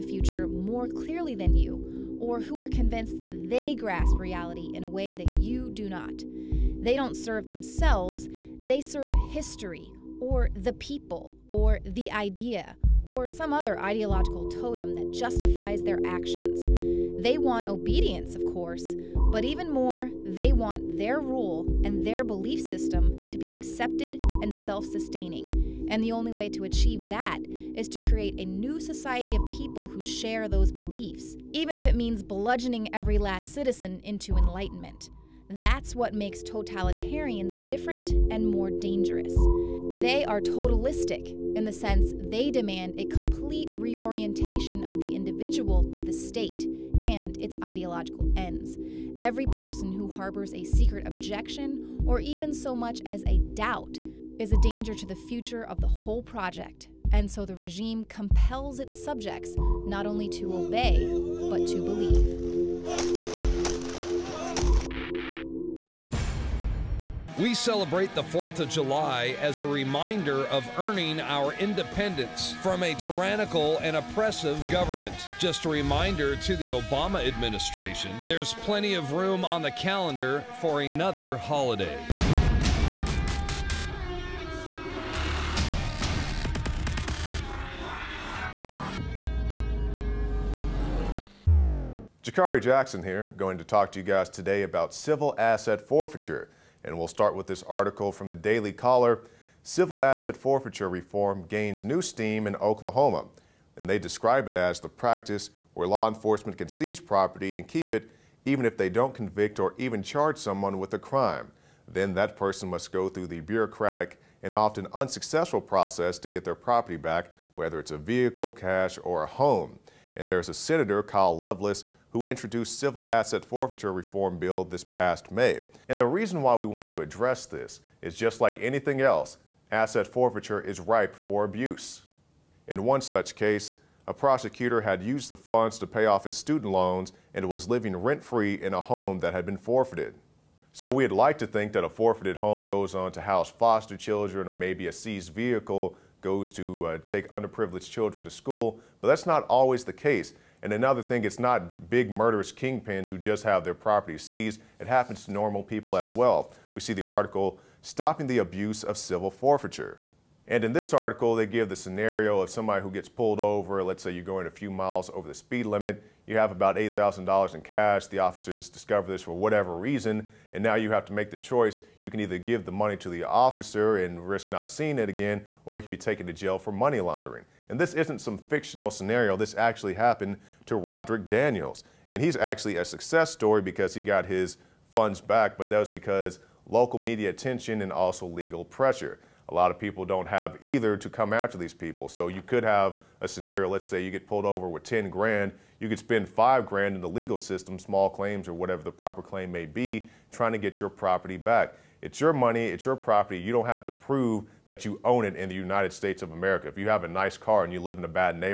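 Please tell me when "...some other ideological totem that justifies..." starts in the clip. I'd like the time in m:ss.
0:13.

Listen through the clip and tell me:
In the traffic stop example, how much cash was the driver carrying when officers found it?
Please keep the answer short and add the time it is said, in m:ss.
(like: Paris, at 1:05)
$8,000, at 2:46.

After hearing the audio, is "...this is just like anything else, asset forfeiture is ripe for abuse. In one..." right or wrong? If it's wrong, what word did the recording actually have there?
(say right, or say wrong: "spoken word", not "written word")
right.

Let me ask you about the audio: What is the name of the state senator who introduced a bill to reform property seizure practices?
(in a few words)
Kyle Loveless.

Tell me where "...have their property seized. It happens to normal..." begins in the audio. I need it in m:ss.
2:33.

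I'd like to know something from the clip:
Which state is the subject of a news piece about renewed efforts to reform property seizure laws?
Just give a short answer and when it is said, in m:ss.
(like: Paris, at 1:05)
Oklahoma, at 1:42.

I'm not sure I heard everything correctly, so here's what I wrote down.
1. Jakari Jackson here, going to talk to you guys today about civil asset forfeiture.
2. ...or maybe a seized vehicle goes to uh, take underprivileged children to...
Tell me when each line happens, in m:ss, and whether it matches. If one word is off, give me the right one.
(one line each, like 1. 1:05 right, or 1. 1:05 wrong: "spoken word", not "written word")
1. 1:32 right
2. 2:24 right.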